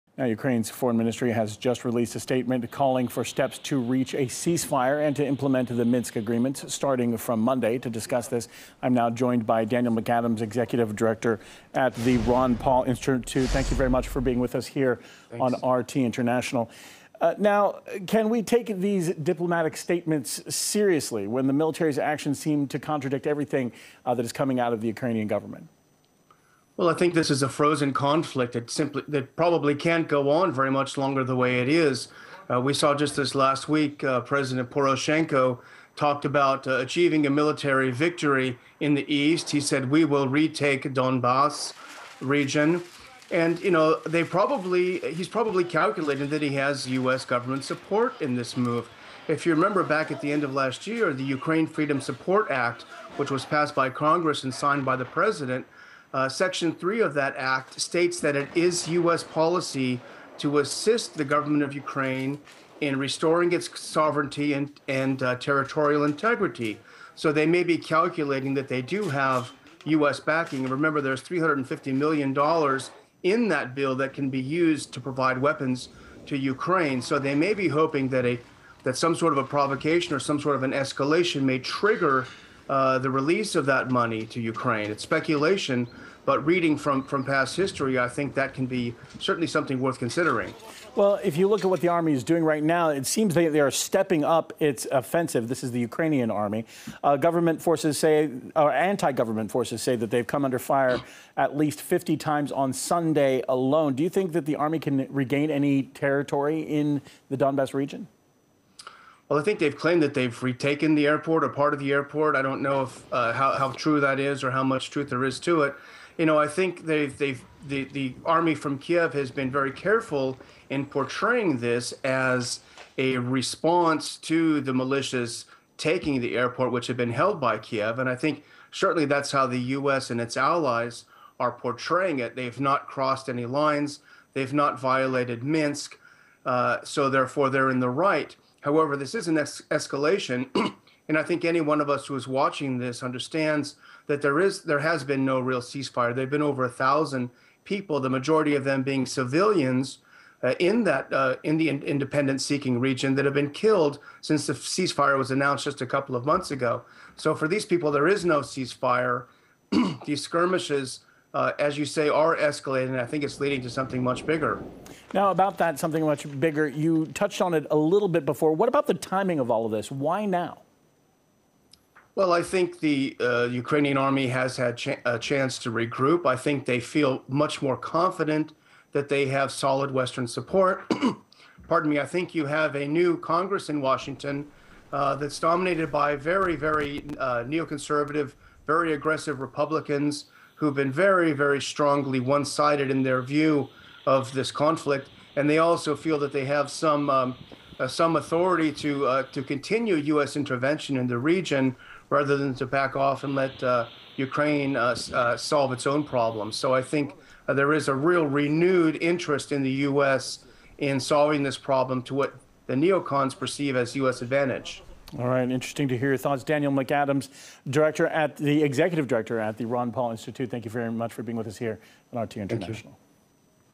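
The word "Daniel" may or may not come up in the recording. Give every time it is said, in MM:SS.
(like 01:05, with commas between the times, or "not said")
00:09, 03:36.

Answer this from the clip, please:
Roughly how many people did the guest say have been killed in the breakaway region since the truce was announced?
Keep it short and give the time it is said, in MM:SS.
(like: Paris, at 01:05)
over 1,000, at 02:26.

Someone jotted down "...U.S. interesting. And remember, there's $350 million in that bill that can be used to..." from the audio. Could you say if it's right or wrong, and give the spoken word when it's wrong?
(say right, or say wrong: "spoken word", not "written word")
wrong: "backing", not "interesting".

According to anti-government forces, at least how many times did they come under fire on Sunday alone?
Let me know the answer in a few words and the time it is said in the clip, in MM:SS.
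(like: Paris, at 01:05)
50, at 01:41.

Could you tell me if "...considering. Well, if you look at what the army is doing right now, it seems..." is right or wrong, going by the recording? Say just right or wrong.
right.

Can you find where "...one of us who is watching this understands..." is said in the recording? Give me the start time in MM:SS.
02:21.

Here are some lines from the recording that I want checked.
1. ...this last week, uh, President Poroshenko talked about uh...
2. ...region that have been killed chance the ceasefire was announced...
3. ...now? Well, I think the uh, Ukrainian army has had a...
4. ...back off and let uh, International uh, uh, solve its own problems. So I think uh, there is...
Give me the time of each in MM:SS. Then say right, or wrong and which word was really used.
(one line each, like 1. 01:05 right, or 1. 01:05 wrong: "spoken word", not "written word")
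1. 00:33 right
2. 02:32 wrong: "since", not "chance"
3. 02:50 right
4. 03:22 wrong: "Ukraine", not "International".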